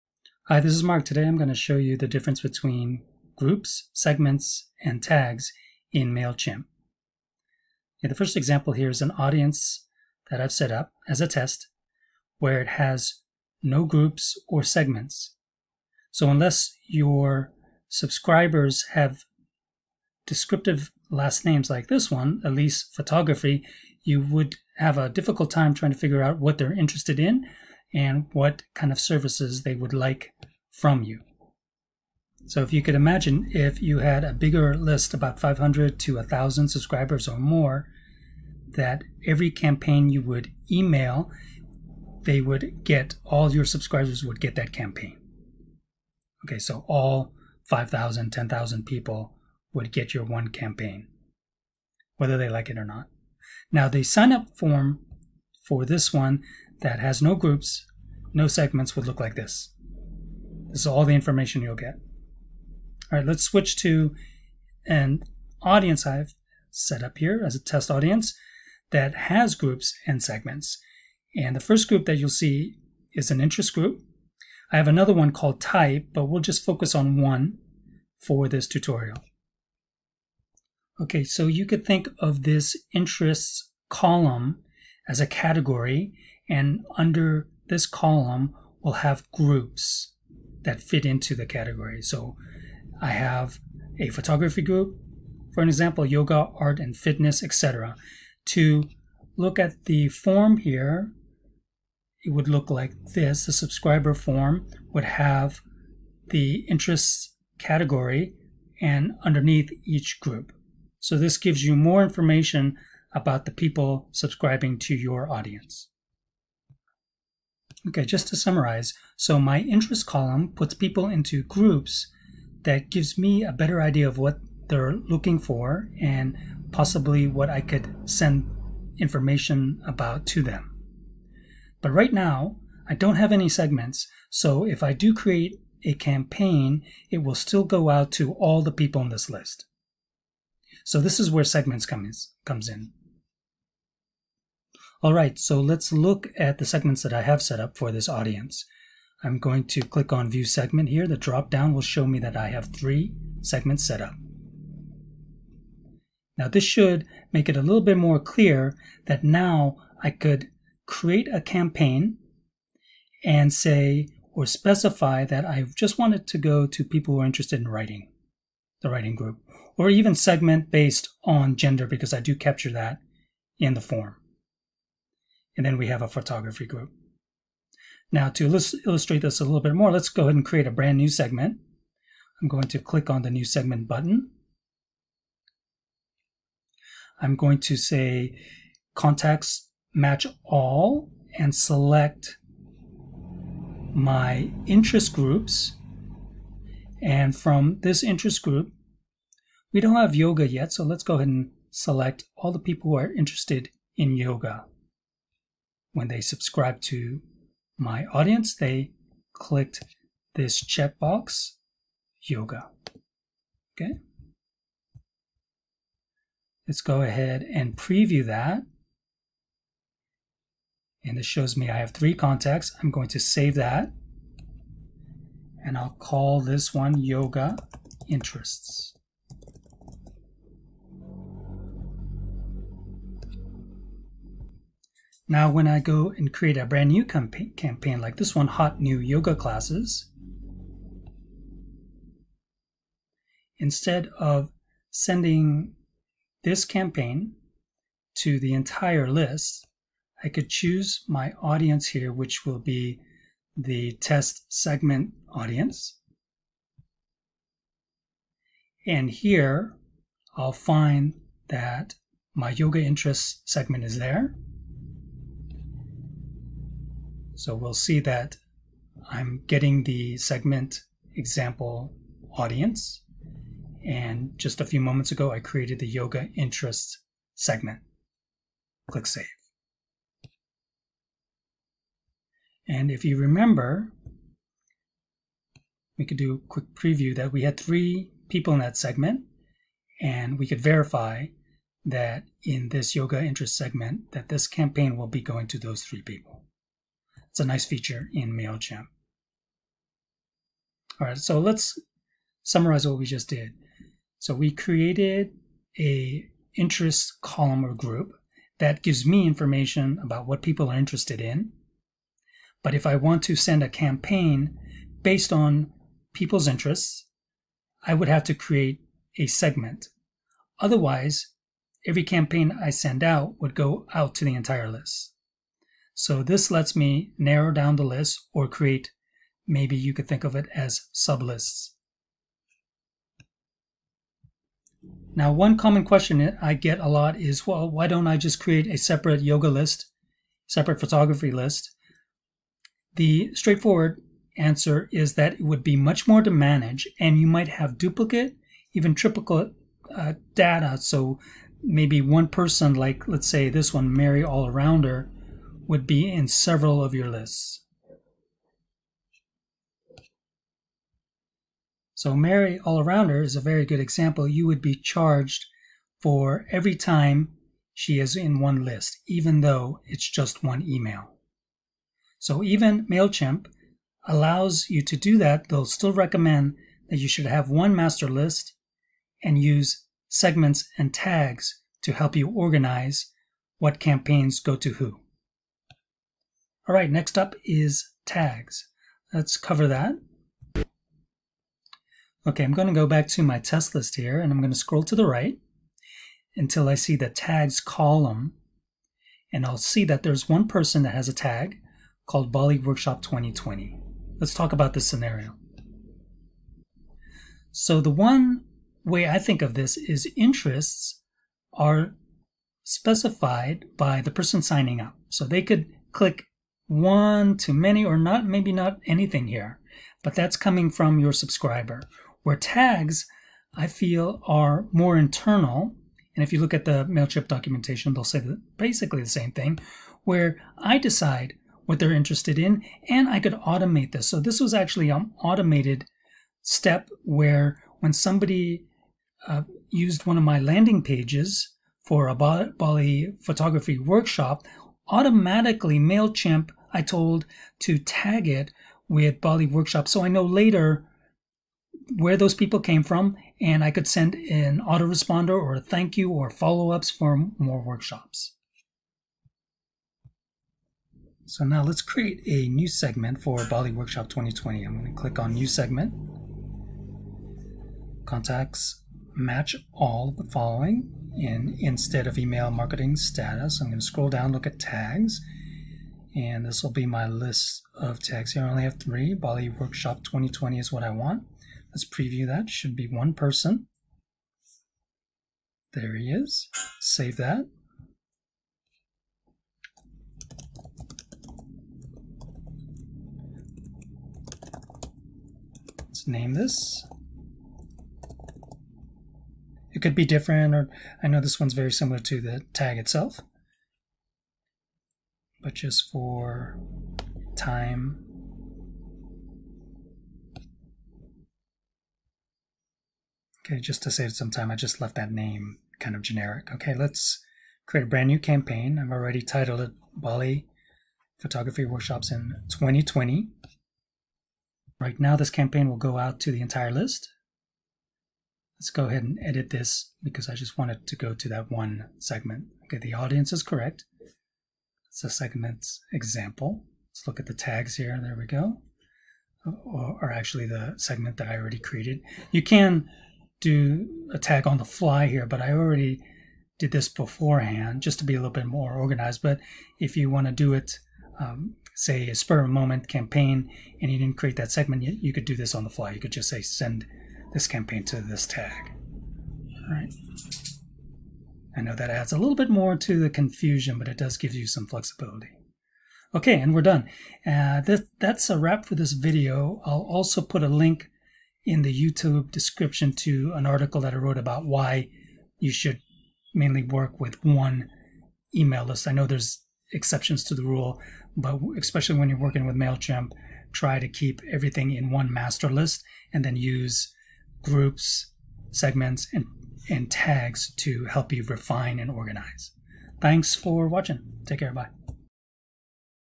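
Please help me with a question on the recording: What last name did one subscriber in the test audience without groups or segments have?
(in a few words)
Elise Photography.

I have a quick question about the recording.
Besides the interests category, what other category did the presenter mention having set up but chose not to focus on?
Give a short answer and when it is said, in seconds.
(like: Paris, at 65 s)
type, at 75 s.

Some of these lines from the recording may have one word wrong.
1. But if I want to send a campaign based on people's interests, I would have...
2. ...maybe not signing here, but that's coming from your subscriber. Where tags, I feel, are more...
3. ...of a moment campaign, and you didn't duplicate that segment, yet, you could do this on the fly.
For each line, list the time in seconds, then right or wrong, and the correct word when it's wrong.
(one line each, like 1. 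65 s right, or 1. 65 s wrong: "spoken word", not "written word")
1. 312 s right
2. 418 s wrong: "anything", not "signing"
3. 552 s wrong: "create", not "duplicate".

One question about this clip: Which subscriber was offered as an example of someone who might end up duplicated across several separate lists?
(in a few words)
Mary All Arounder.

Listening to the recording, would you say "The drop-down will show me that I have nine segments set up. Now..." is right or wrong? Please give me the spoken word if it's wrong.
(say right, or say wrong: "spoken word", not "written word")
wrong: "three", not "nine".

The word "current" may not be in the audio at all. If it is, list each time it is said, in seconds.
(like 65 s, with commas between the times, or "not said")
not said.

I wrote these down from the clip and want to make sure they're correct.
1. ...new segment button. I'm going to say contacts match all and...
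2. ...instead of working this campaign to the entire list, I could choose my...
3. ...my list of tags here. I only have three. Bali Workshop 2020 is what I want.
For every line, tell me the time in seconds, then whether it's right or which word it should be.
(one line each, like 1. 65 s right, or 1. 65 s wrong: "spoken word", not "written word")
1. 183 s right
2. 243 s wrong: "sending", not "working"
3. 476 s right.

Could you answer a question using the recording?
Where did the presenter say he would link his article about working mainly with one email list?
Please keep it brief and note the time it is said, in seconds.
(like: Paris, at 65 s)
YouTube description, at 571 s.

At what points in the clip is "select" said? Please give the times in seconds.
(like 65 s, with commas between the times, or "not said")
191 s, 201 s.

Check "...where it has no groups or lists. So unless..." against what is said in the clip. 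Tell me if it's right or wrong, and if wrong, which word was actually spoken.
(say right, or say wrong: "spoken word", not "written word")
wrong: "segments", not "lists".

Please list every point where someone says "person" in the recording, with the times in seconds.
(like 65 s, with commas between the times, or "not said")
352 s, 400 s, 414 s, 483 s.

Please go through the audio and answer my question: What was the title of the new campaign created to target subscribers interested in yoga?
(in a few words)
Hot New Yoga Classes.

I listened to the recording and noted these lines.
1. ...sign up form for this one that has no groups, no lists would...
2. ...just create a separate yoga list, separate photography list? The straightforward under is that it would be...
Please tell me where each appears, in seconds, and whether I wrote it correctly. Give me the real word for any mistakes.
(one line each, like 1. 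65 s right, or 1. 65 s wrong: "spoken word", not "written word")
1. 54 s wrong: "segments", not "lists"
2. 338 s wrong: "answer", not "under".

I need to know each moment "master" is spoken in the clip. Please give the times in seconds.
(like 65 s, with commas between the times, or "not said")
377 s, 585 s.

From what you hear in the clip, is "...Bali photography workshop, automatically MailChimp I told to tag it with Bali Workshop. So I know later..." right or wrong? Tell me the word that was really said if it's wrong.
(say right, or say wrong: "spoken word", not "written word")
right.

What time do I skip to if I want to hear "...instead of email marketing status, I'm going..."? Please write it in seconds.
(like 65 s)
471 s.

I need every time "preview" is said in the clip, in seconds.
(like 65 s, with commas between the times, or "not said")
217 s, 286 s, 481 s.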